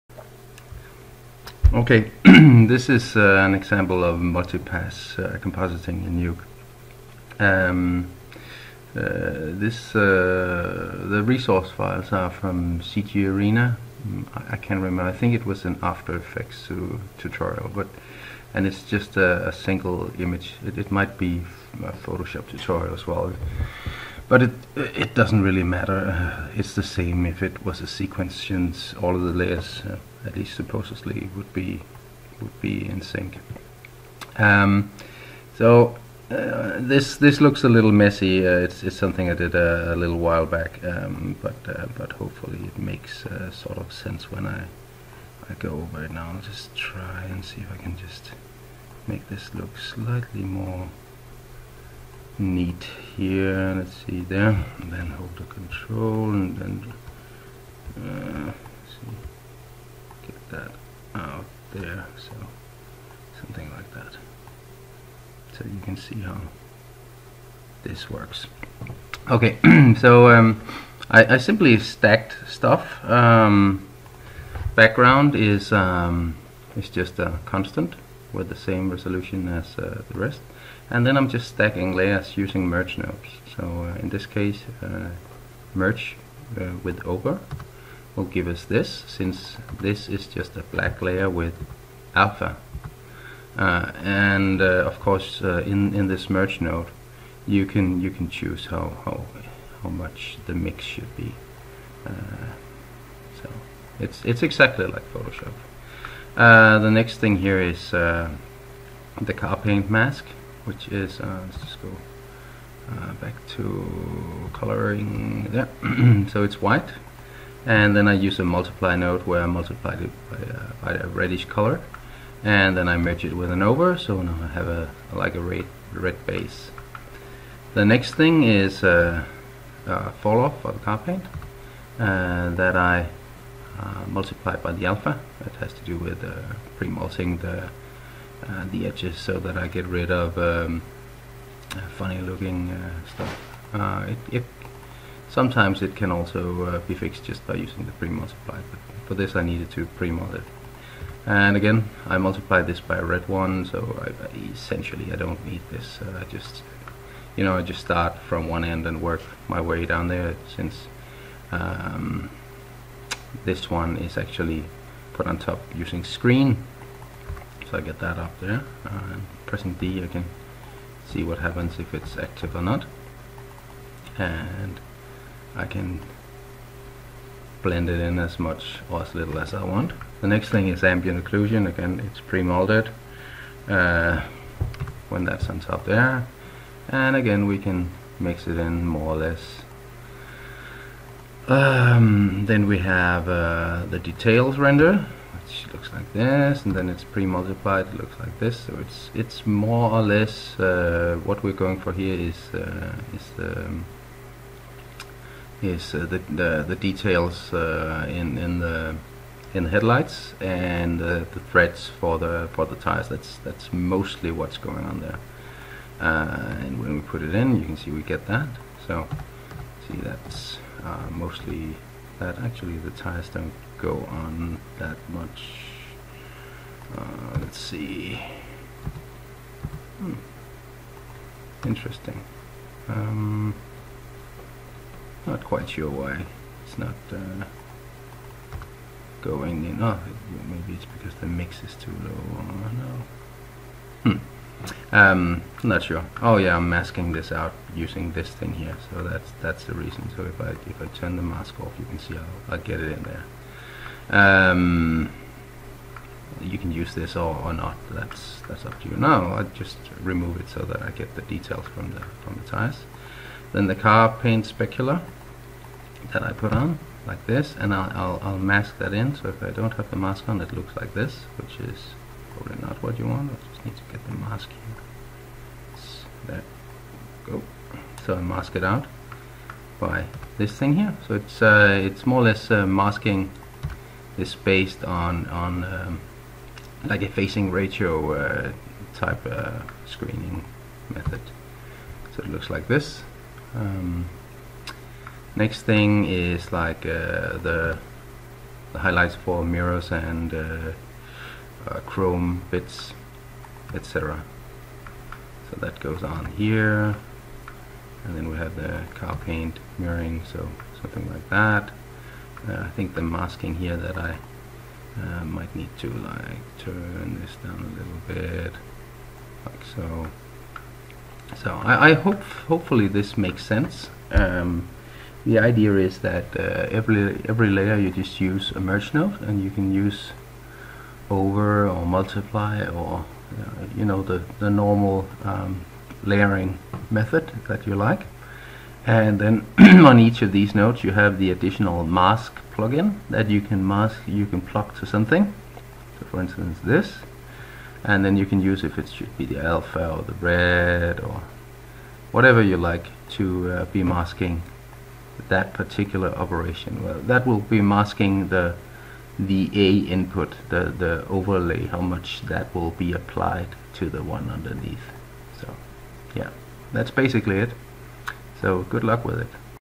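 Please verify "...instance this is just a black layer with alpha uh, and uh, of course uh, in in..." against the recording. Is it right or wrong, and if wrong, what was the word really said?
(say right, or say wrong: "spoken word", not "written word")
wrong: "since", not "instance".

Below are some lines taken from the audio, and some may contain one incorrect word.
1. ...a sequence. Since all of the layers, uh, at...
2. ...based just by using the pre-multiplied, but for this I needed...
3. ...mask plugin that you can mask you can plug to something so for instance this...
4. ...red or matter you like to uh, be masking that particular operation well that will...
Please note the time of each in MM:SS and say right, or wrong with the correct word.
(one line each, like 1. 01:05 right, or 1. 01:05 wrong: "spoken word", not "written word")
1. 00:27 right
2. 02:26 wrong: "fixed", not "based"
3. 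05:41 right
4. 05:50 wrong: "whatever", not "matter".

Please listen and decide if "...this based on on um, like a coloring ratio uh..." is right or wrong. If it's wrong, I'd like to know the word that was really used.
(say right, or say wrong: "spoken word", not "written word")
wrong: "facing", not "coloring".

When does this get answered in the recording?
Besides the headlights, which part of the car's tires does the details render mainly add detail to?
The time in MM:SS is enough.
03:31.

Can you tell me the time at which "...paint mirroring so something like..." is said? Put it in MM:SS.
05:09.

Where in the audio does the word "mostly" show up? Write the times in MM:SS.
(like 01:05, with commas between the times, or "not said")
03:33, 03:41.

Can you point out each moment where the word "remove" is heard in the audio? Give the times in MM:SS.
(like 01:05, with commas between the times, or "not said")
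04:20.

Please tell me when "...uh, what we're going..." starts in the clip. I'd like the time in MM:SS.
03:20.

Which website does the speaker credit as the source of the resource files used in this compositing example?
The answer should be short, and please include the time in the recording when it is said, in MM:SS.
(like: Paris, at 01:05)
CG Arena, at 00:12.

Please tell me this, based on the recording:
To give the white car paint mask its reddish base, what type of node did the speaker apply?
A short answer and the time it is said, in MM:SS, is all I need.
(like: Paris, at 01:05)
multiply node, at 01:58.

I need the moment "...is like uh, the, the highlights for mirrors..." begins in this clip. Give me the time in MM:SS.
04:56.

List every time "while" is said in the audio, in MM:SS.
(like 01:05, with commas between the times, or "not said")
00:40.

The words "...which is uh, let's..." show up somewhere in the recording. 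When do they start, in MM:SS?
01:50.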